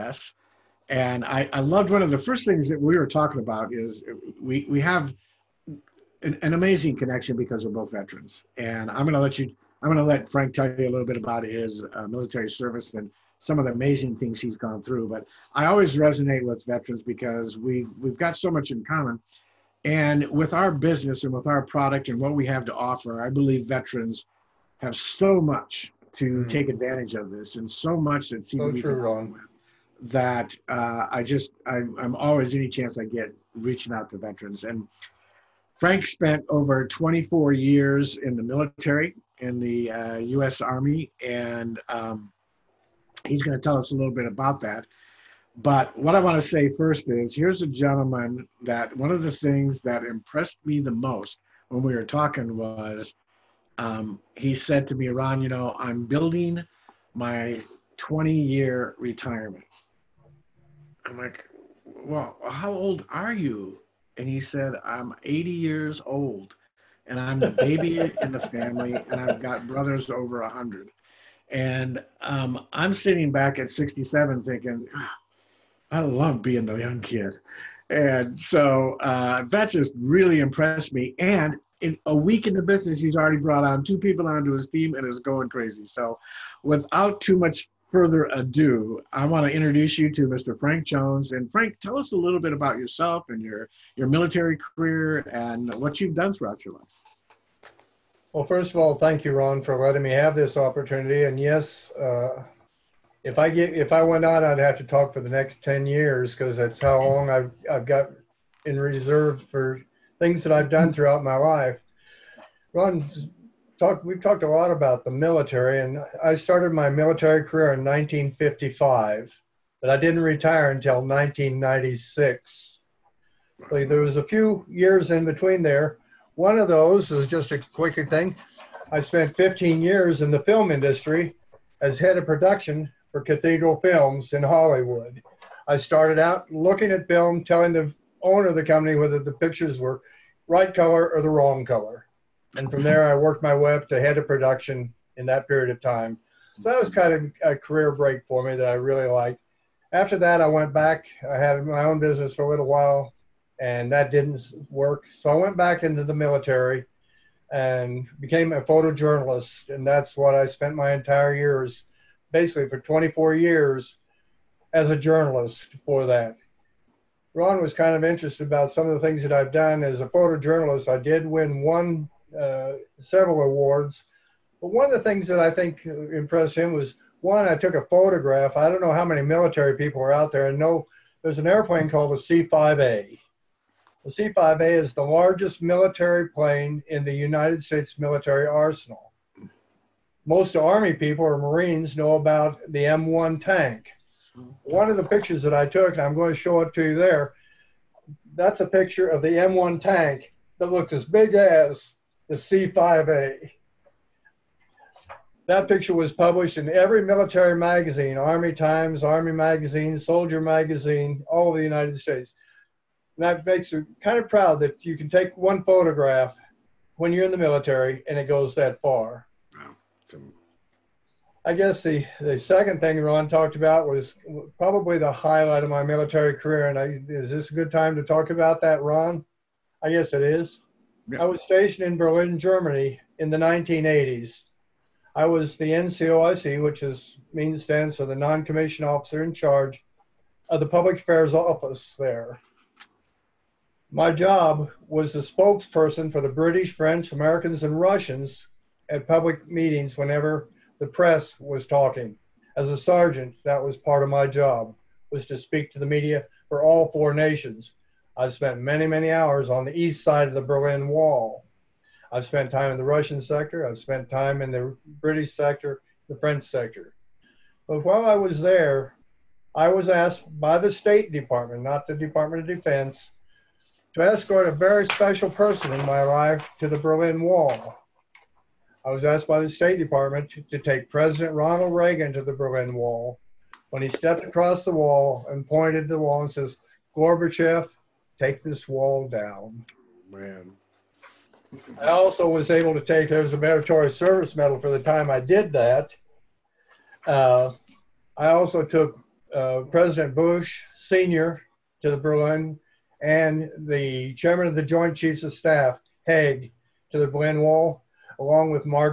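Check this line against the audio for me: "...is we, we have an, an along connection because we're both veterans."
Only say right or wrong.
wrong.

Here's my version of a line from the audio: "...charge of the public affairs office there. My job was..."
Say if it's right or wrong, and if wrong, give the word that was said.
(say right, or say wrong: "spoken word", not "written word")
right.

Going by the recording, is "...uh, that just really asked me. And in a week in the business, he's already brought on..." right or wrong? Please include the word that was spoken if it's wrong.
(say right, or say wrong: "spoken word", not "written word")
wrong: "impressed", not "asked".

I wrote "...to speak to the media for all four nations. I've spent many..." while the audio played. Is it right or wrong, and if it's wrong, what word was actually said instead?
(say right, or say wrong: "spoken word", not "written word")
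right.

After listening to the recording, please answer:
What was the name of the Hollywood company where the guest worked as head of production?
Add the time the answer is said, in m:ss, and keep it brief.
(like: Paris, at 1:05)
Cathedral Films, at 2:13.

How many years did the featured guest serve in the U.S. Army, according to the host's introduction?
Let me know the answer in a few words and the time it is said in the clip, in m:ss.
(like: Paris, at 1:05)
24 years, at 0:36.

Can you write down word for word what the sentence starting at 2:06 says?
One of those is just a quick thing.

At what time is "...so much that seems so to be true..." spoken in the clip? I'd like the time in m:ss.
0:27.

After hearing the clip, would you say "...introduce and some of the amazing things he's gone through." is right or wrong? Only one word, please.
wrong.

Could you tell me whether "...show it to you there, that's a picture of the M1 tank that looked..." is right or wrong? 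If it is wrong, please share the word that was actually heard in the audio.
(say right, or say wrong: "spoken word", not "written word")
right.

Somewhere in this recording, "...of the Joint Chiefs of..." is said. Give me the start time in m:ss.
5:04.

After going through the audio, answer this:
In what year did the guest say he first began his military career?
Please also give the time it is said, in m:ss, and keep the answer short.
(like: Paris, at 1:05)
1955, at 1:57.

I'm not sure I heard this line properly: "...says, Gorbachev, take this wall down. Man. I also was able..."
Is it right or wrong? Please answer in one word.
right.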